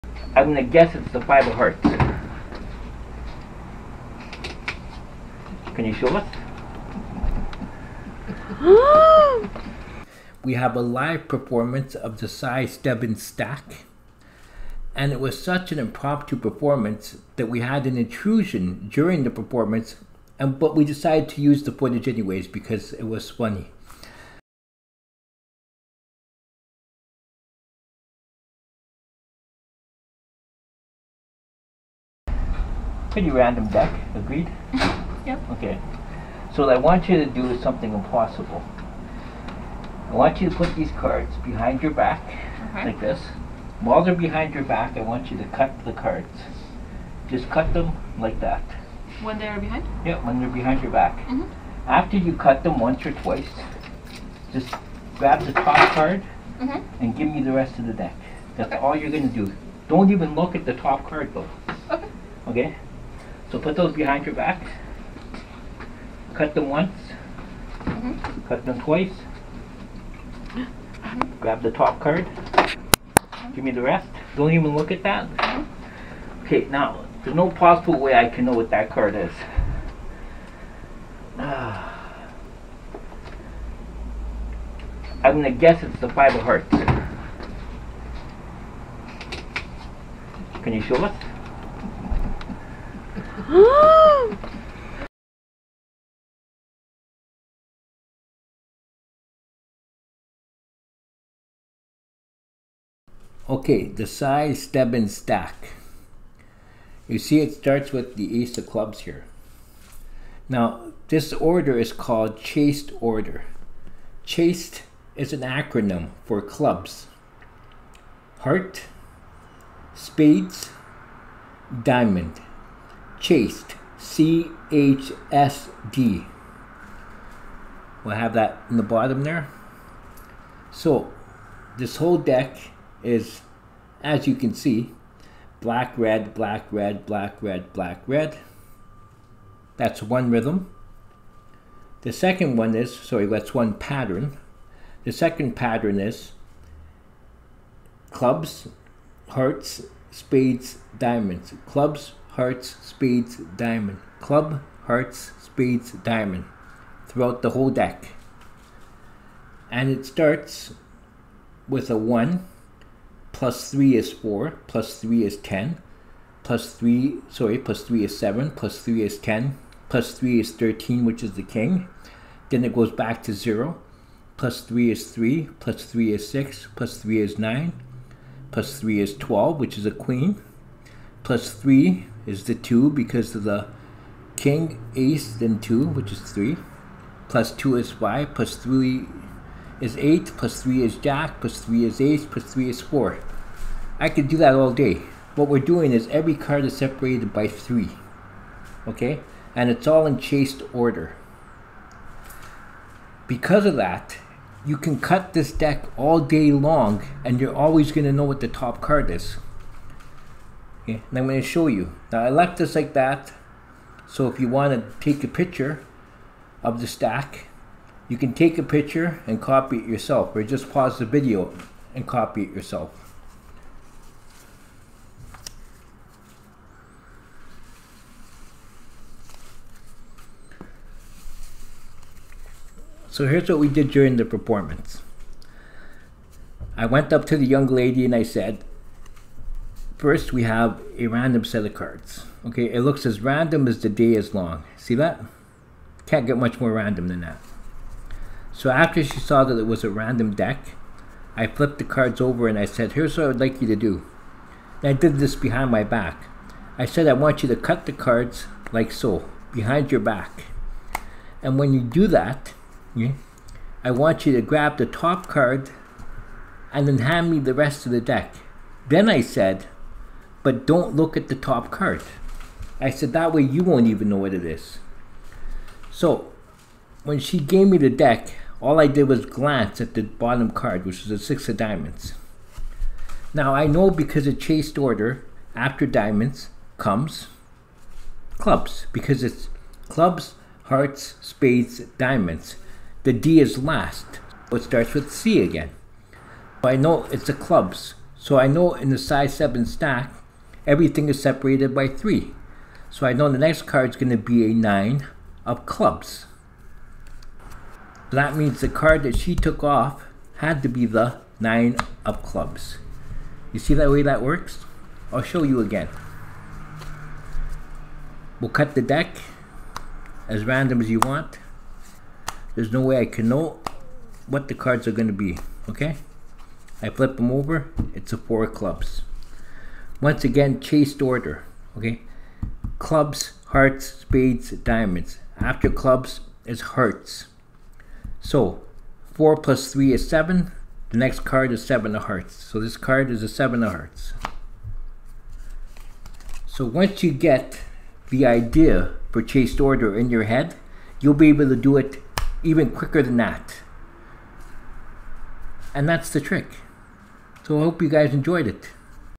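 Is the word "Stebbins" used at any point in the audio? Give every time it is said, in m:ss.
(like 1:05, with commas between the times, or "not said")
0:12, 1:44, 4:59.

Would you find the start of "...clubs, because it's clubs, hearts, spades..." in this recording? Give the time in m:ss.
4:48.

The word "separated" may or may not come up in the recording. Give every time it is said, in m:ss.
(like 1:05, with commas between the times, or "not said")
3:16, 5:01.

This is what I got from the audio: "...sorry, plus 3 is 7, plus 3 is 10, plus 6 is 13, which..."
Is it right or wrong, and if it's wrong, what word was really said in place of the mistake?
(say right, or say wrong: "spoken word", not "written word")
wrong: "3", not "6".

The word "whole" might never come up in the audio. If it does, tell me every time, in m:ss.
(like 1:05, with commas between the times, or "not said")
2:11, 2:37.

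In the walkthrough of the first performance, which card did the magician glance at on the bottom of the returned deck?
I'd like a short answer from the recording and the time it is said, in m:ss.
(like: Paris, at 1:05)
Six of diamonds, at 4:41.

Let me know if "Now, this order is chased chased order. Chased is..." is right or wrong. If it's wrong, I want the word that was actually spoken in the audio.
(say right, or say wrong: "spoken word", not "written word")
wrong: "called", not "chased".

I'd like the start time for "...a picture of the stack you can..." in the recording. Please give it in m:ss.
3:35.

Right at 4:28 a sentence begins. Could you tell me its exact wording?
Then I said, but don't look at the top card.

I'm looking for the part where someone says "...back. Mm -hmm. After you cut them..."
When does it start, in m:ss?
0:50.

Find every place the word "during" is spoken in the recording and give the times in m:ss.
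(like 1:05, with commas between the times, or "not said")
0:18, 3:53.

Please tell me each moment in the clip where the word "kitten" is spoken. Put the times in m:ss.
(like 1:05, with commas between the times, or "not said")
not said.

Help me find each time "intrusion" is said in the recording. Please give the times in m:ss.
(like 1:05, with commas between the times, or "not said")
0:17.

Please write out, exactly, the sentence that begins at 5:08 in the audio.
That means the card that she took off had to be the 9 of clubs.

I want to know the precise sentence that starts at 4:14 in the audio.
And I did this behind my back.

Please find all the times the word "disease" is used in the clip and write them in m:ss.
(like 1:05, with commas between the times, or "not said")
not said.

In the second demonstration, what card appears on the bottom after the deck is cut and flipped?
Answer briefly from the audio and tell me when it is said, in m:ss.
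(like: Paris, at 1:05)
4 of clubs, at 5:28.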